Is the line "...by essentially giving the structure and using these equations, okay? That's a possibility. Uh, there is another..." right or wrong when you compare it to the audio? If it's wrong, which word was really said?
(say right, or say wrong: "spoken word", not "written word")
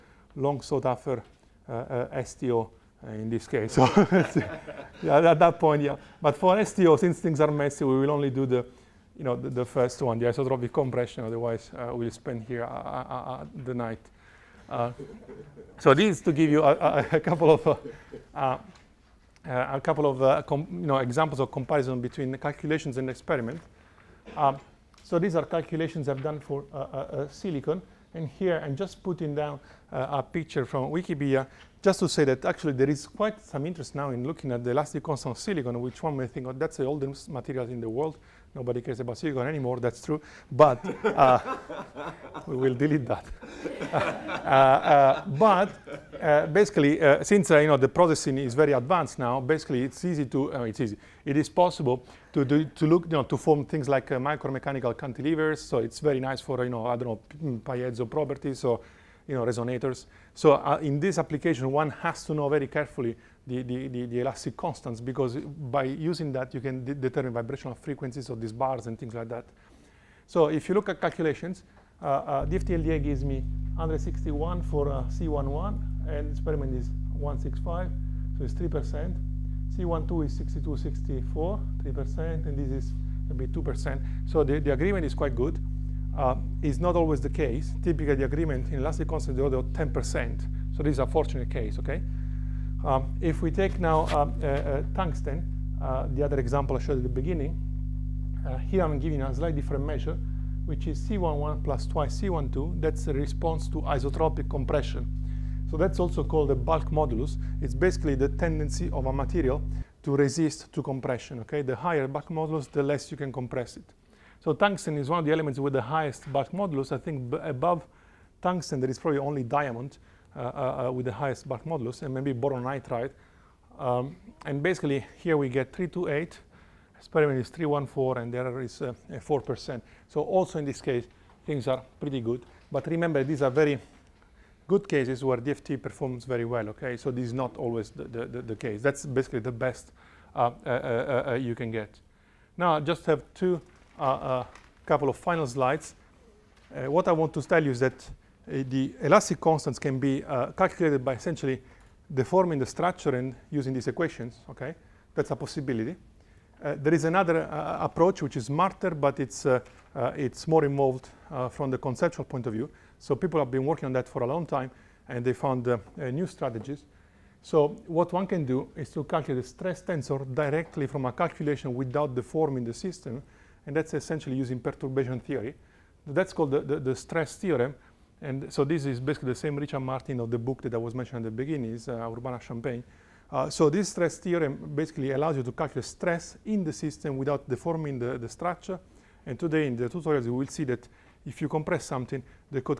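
wrong: "deforming", not "giving".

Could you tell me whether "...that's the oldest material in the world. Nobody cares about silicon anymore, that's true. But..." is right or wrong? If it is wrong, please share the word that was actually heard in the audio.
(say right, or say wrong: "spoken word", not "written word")
right.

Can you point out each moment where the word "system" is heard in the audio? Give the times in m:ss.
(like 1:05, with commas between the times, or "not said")
2:52, 3:06.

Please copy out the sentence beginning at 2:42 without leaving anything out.
So people have been working on that for a long time, and they found new strategies.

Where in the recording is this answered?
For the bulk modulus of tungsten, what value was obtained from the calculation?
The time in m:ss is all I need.
2:05.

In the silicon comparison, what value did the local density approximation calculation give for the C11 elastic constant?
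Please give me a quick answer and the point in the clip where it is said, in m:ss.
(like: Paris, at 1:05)
161, at 1:13.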